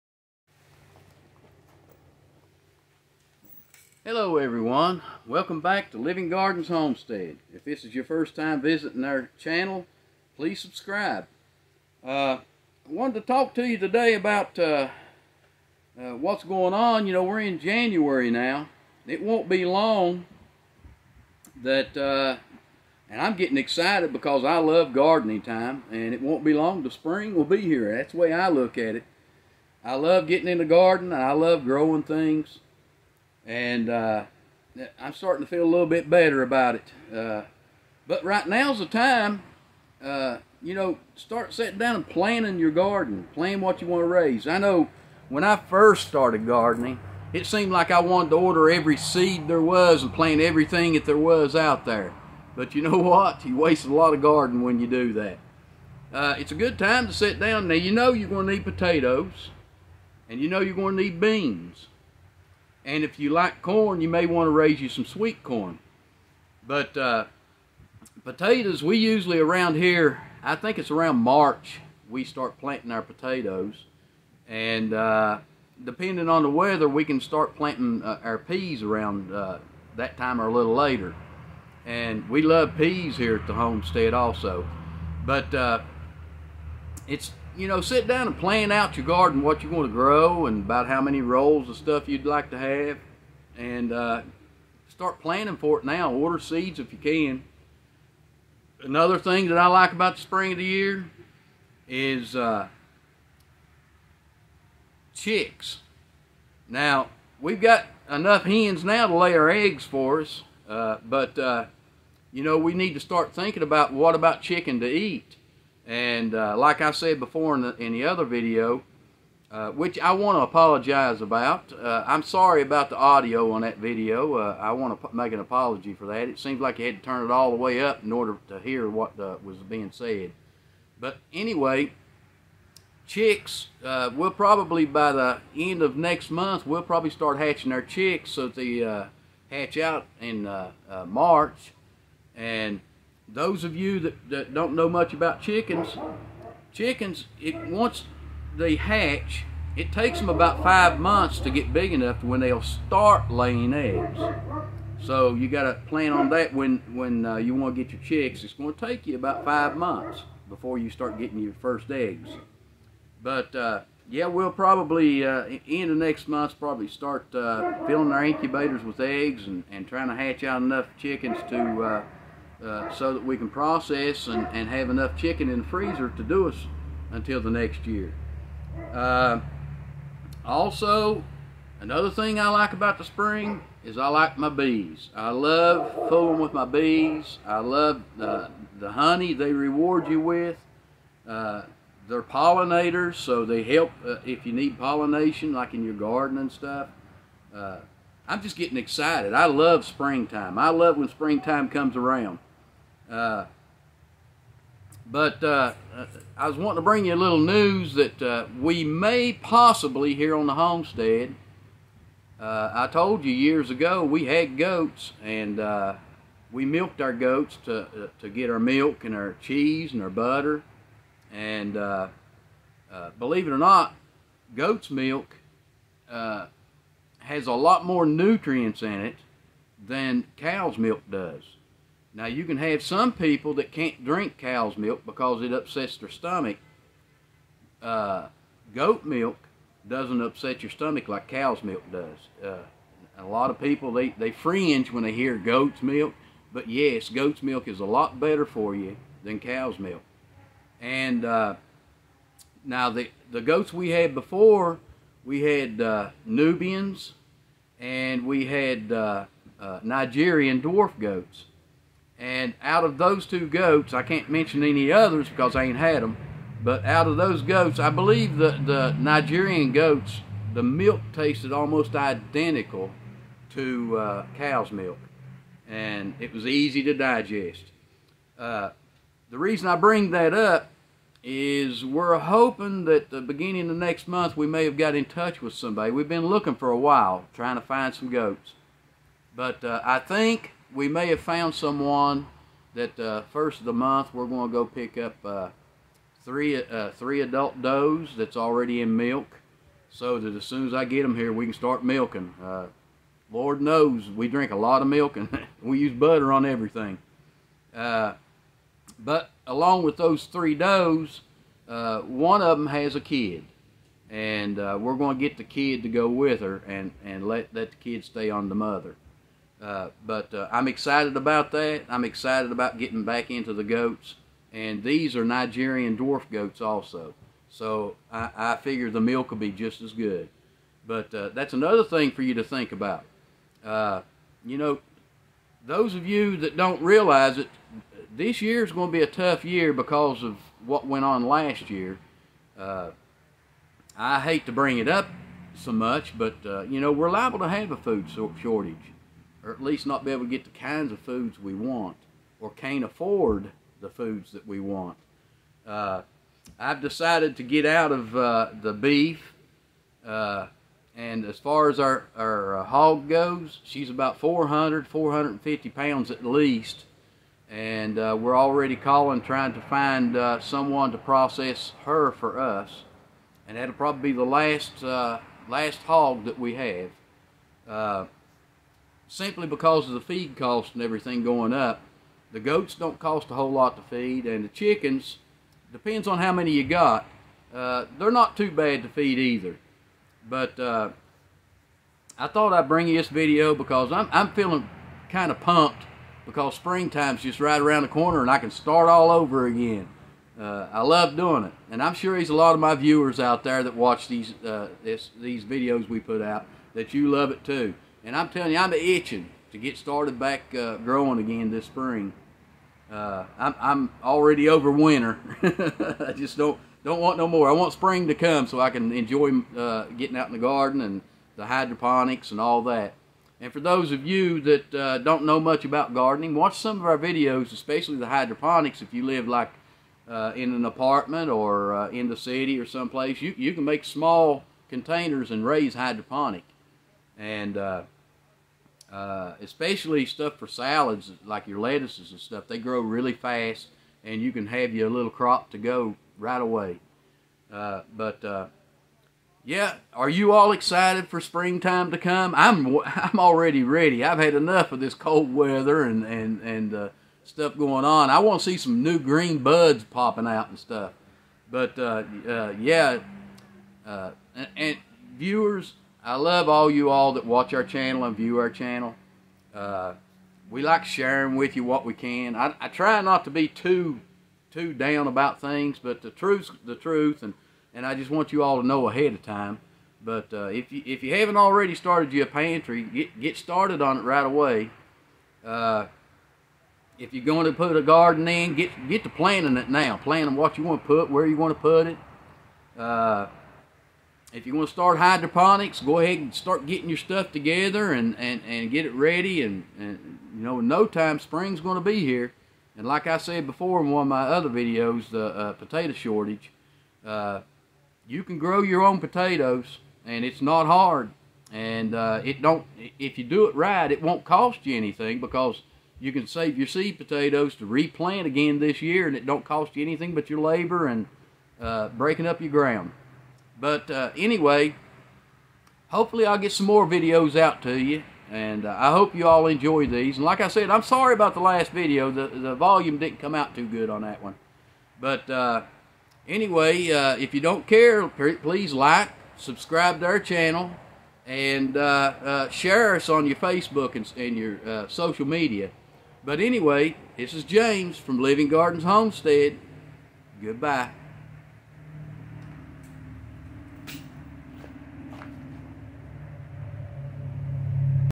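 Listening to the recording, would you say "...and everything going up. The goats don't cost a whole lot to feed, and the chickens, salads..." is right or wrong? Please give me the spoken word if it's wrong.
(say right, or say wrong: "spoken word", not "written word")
wrong: "depends", not "salads".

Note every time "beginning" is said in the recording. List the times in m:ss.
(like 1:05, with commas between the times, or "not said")
4:43.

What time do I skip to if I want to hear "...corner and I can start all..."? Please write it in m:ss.
6:37.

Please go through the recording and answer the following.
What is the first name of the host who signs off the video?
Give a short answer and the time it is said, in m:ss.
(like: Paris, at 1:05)
James, at 9:07.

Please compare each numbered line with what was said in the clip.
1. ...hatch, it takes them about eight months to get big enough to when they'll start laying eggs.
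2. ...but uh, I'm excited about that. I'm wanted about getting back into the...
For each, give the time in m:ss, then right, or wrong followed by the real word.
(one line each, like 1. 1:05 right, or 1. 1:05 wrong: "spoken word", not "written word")
1. 2:28 wrong: "five", not "eight"
2. 5:20 wrong: "excited", not "wanted".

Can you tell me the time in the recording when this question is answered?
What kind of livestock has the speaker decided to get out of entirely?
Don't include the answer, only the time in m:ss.
5:58.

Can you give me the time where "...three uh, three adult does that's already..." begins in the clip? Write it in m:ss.
4:56.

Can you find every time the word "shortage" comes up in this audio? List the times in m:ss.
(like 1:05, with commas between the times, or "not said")
5:48, 8:25.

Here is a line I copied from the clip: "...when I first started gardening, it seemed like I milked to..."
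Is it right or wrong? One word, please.
wrong.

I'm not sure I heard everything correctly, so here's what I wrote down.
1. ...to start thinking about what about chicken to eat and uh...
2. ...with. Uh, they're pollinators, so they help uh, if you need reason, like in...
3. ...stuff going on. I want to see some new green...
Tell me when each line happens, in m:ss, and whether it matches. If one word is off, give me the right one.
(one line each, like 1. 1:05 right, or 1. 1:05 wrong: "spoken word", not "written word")
1. 1:52 right
2. 3:10 wrong: "pollination", not "reason"
3. 7:37 right.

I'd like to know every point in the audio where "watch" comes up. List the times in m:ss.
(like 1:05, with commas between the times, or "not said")
6:43, 7:06, 7:47.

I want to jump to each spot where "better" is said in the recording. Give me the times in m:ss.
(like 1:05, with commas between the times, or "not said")
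0:36, 4:08.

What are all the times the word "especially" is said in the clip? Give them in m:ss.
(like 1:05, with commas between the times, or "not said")
7:07, 7:19.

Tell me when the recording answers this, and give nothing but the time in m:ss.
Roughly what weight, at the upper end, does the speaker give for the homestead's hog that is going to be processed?
6:04.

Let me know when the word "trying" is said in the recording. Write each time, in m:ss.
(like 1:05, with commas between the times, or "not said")
2:49, 4:47, 6:09.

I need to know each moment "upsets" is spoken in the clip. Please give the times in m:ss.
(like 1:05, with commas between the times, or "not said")
3:55, 4:00.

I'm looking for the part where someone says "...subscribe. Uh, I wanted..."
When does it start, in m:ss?
0:10.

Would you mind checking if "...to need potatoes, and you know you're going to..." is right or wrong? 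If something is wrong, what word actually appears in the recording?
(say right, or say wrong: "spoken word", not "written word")
right.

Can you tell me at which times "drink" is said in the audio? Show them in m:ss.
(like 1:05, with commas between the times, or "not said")
3:54, 5:04.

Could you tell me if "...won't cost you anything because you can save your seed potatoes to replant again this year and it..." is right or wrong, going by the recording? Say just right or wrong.
right.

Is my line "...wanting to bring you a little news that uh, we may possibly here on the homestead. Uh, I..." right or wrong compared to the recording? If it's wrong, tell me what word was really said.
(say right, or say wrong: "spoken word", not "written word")
right.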